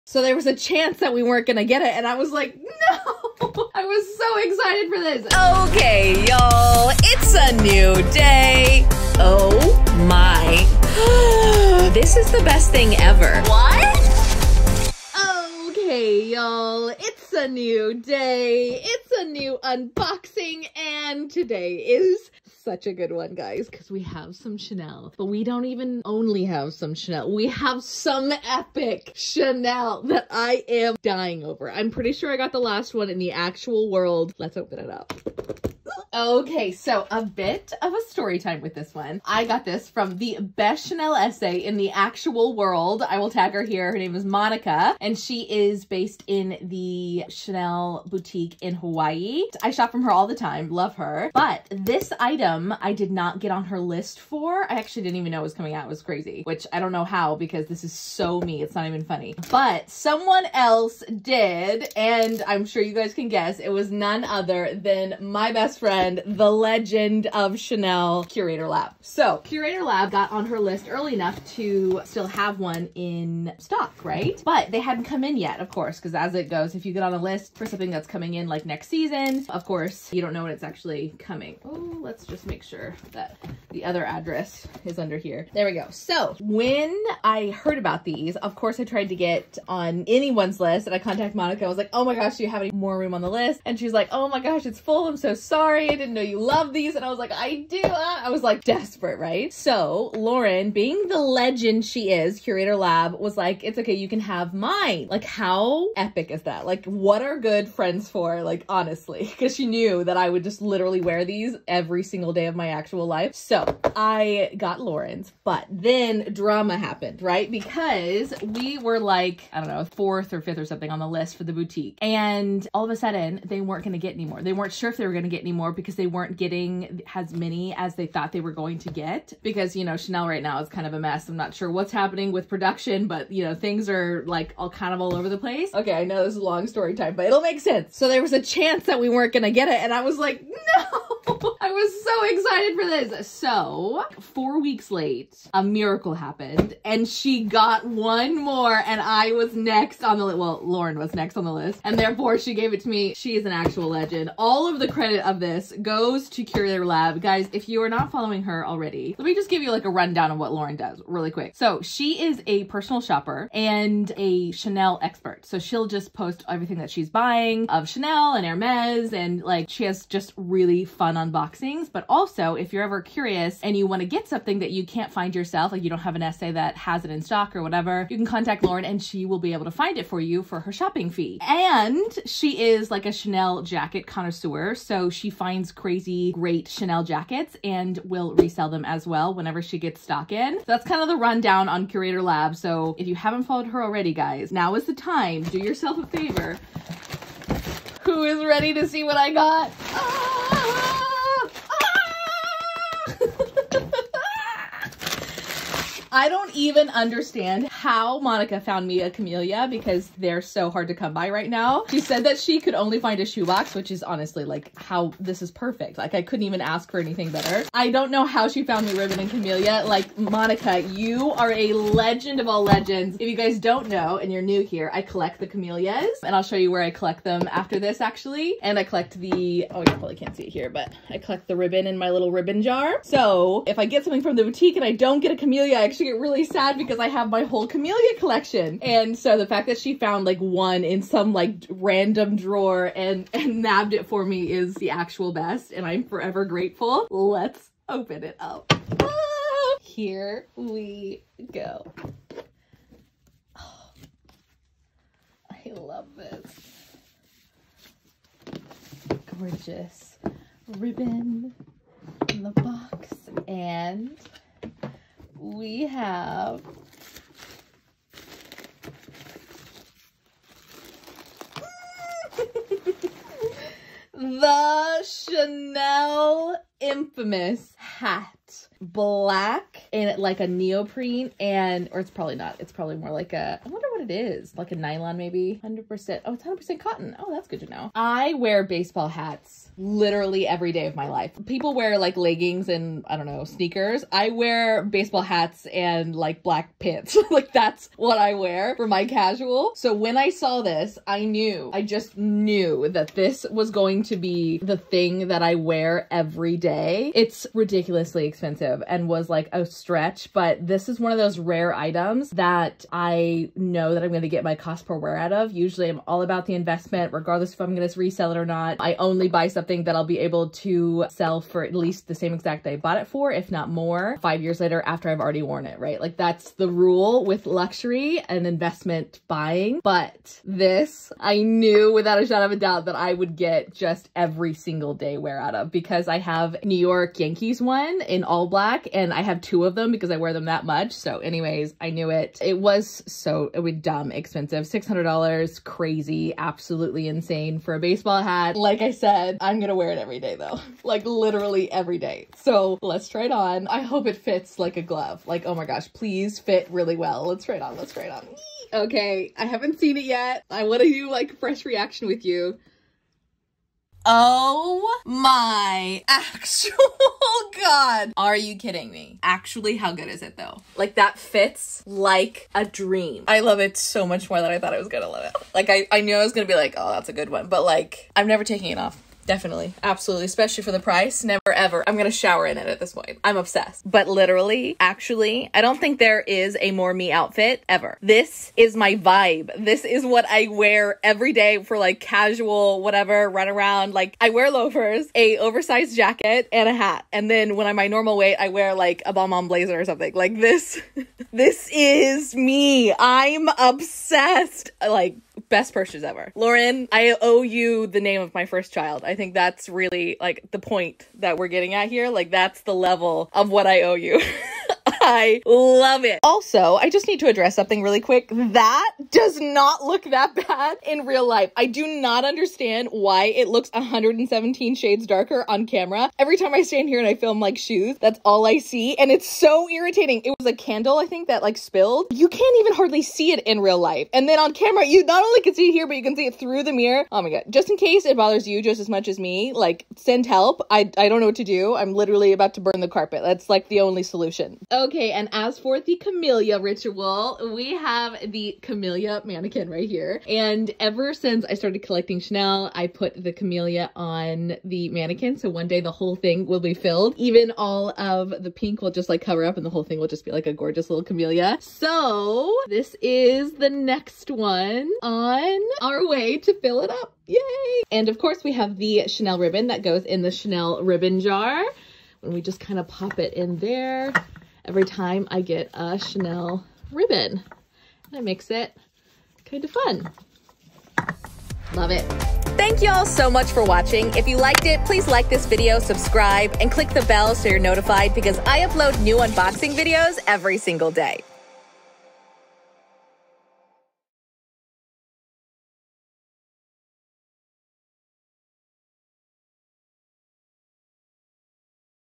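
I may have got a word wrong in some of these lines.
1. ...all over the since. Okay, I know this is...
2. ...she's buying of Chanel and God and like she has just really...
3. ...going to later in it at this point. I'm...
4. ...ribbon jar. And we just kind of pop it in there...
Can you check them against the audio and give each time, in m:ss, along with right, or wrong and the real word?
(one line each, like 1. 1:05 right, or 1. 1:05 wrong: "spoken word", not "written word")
1. 2:15 wrong: "place", not "since"
2. 2:46 wrong: "Hermes", not "God"
3. 6:21 wrong: "shower", not "later"
4. 7:50 right.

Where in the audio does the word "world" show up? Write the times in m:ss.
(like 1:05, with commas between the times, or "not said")
0:33, 0:42.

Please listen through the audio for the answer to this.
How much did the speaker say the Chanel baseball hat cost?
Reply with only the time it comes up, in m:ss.
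5:44.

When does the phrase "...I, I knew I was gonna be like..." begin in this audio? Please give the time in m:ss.
6:15.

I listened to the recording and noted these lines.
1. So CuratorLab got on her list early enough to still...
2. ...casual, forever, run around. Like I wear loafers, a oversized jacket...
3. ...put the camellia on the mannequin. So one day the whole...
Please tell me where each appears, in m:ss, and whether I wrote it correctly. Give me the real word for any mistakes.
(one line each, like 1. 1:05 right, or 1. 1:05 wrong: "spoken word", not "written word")
1. 1:09 right
2. 6:31 wrong: "whatever", not "forever"
3. 7:32 right.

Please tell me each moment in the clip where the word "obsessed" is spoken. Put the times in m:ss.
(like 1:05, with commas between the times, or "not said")
6:23, 6:43.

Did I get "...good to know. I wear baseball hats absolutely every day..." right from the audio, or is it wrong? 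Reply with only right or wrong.
wrong.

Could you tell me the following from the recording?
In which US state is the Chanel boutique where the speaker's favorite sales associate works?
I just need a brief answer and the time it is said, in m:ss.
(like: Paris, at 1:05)
Hawaii, at 0:48.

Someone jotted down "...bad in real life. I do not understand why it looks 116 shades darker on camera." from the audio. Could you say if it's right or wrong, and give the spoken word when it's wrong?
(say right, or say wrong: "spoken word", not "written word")
wrong: "117", not "116".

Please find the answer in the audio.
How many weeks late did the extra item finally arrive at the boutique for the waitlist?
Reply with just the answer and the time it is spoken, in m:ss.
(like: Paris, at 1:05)
4, at 2:24.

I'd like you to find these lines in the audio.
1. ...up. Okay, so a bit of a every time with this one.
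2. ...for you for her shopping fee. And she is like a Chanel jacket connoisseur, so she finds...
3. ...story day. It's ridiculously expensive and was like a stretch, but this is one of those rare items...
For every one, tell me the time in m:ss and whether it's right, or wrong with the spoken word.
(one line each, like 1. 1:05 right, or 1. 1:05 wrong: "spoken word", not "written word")
1. 0:34 wrong: "story", not "every"
2. 3:00 right
3. 5:06 wrong: "every", not "story".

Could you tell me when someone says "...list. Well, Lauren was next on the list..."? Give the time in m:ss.
2:30.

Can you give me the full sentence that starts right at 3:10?
So that's kind of the rundown on CuratorLab.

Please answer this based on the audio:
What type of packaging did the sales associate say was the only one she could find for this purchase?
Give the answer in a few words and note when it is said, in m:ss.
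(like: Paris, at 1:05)
A shoebox, at 3:33.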